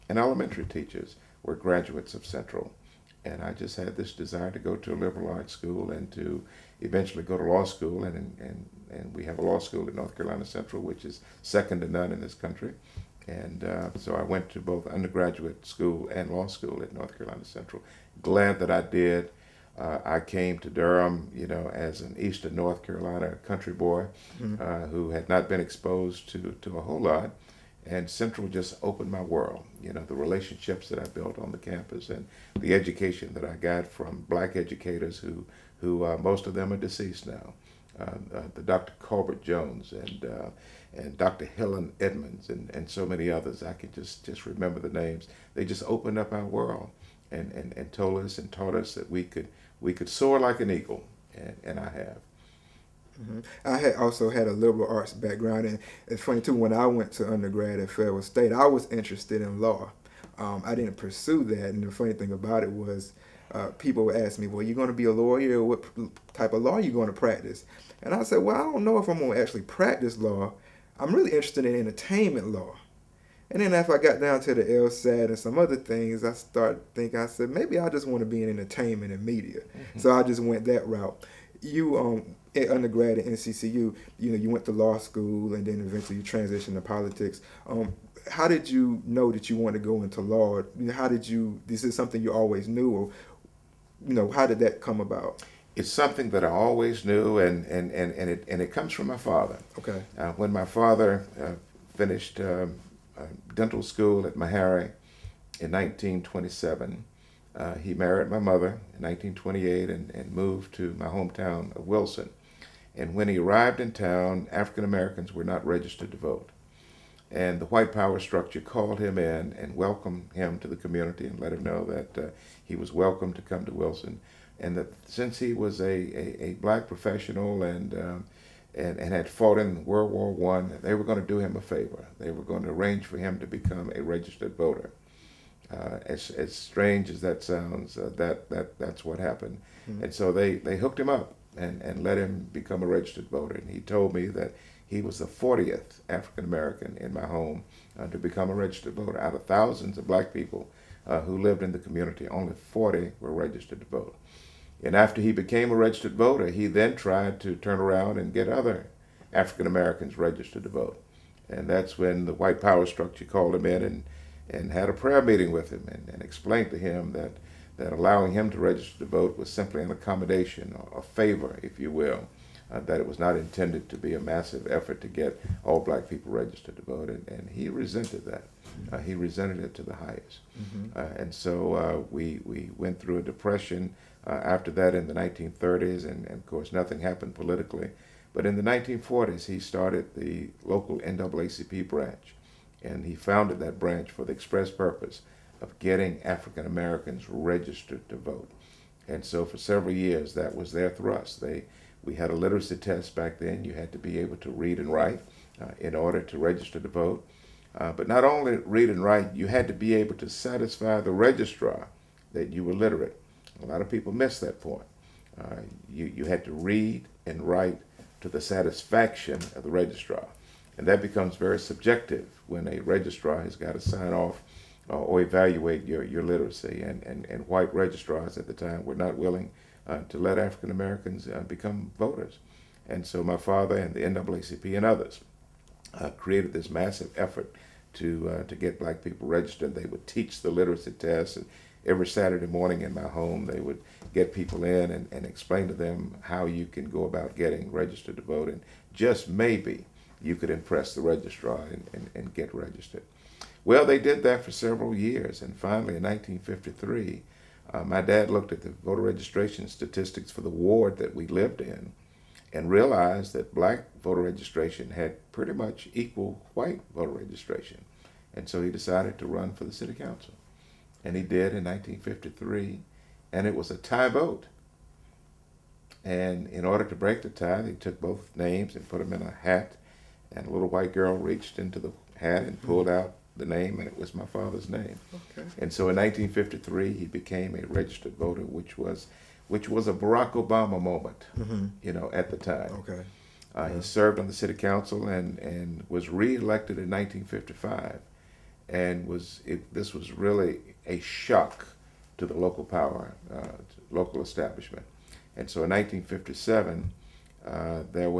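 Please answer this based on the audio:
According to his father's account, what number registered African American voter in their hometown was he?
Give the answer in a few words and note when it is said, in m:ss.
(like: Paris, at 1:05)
40th, at 2:25.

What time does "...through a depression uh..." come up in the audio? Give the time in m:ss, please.
3:02.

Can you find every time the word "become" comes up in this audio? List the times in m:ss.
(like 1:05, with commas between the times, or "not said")
2:13, 2:22, 2:28, 3:41, 3:51.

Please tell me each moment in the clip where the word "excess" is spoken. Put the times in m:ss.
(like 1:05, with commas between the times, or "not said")
not said.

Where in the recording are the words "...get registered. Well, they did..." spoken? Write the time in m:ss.
4:12.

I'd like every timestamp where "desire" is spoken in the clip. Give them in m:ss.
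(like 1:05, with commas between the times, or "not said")
0:04.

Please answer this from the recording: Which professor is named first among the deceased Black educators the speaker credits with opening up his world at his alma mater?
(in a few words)
Dr. Colbert Jones.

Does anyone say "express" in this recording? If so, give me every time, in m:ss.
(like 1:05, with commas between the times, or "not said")
3:14.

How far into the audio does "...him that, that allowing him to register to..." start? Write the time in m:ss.
2:46.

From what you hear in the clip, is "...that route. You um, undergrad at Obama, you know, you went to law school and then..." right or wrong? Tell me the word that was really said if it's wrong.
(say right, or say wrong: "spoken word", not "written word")
wrong: "NCCU", not "Obama".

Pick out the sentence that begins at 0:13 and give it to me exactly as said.
And uh, so I went to both undergraduate school and law school at North Carolina Central.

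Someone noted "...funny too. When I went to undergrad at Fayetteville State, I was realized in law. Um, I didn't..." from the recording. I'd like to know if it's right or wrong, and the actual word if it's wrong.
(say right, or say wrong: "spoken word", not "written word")
wrong: "interested", not "realized".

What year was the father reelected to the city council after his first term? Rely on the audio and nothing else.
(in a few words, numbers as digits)
1955.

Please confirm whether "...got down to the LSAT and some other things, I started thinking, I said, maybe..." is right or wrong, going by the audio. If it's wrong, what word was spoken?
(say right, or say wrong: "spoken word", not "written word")
right.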